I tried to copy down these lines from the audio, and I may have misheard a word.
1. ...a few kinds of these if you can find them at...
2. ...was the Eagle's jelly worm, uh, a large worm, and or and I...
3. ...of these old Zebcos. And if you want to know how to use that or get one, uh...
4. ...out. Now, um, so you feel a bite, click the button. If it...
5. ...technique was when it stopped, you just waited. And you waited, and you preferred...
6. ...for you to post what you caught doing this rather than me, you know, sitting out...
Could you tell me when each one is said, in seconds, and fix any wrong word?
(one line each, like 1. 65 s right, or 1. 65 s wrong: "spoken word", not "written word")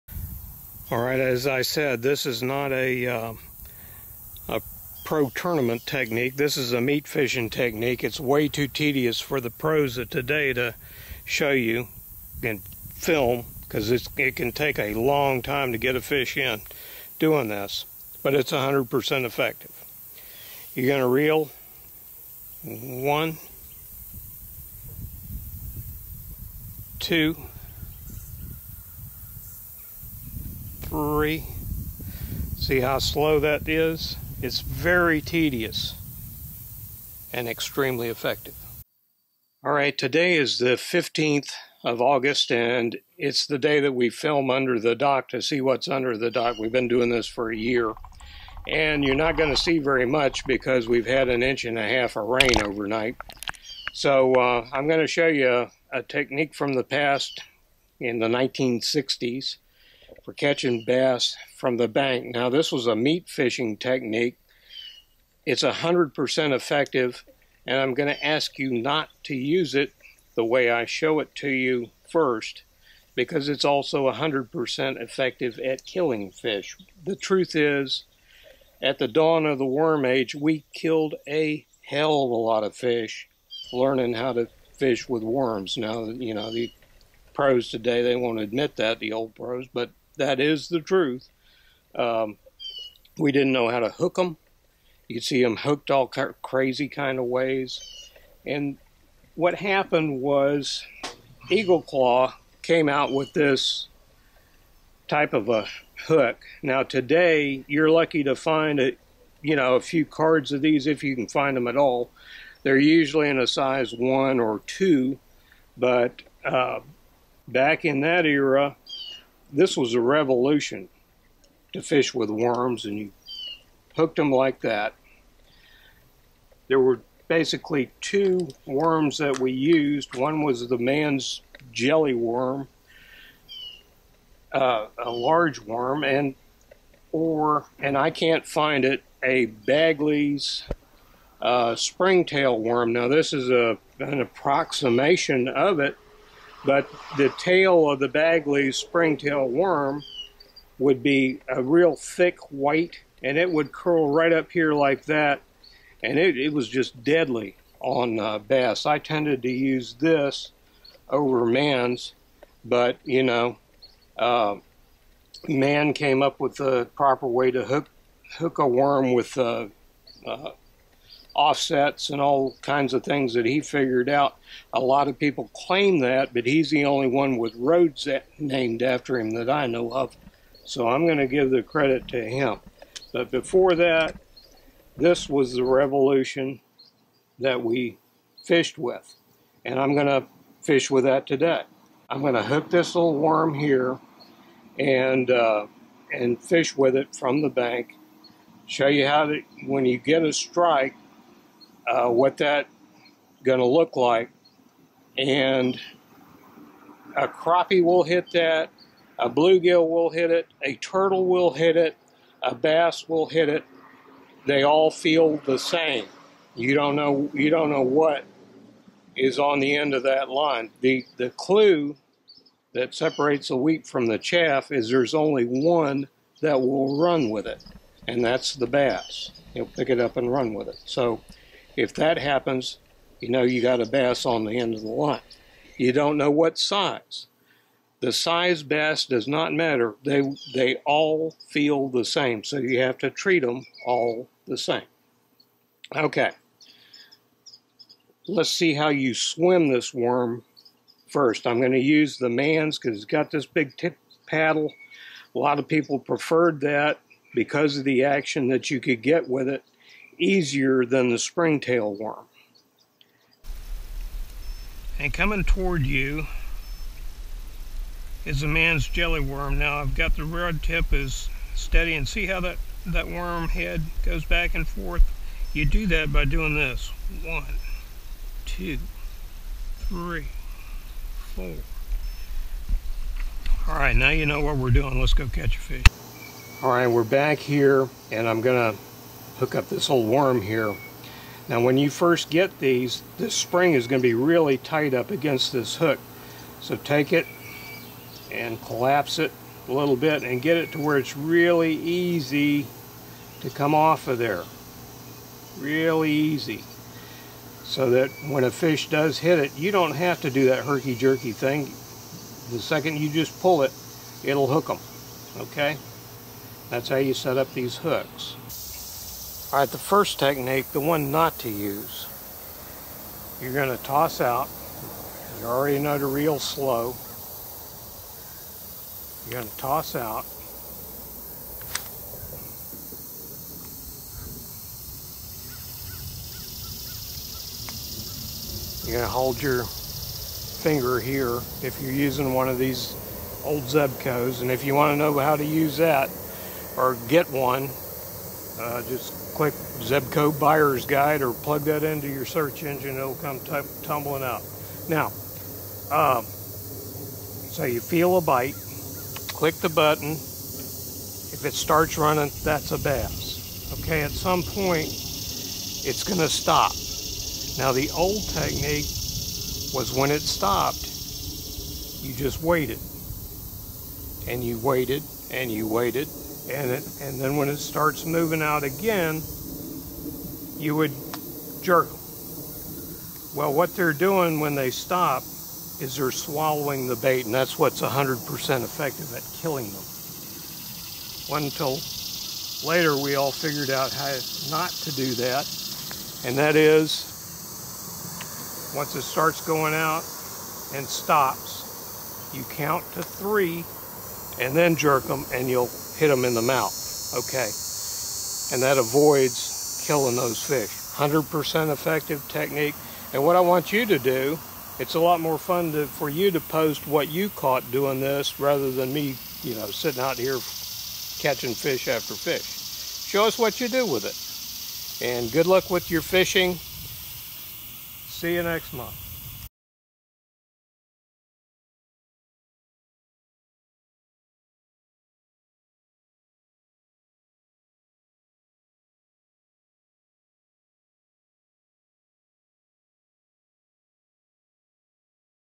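1. 109 s wrong: "cards", not "kinds"
2. 130 s wrong: "Mann", not "Eagle"
3. 342 s right
4. 354 s right
5. 368 s wrong: "waited", not "preferred"
6. 415 s right.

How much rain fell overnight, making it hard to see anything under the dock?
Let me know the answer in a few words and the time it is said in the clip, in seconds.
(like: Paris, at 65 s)
an inch and a half, at 51 s.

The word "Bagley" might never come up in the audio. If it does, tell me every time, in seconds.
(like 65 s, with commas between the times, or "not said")
139 s, 148 s.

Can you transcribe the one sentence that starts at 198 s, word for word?
Show you how to, when you get a strike, uh, what that going to look like.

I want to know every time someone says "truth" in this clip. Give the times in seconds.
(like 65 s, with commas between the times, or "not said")
77 s, 90 s.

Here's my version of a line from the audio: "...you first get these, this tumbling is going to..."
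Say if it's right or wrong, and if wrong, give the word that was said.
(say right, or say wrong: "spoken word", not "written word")
wrong: "spring", not "tumbling".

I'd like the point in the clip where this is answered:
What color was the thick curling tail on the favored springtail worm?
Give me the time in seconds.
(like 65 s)
152 s.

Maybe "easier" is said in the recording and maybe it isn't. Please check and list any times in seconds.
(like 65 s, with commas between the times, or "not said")
260 s.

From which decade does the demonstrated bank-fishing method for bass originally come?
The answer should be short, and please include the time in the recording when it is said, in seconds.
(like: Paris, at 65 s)
1960s, at 58 s.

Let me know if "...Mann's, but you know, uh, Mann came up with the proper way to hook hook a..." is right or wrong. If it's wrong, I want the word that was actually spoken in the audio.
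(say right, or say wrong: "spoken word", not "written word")
right.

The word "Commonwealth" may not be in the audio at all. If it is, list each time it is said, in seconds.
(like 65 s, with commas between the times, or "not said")
not said.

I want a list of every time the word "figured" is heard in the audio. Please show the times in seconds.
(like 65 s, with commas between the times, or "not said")
173 s, 393 s.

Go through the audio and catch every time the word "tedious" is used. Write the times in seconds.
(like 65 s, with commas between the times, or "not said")
8 s, 35 s.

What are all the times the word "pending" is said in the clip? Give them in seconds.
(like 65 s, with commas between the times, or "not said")
not said.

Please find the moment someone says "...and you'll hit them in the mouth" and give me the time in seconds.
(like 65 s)
405 s.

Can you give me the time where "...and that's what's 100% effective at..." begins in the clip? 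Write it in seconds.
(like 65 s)
387 s.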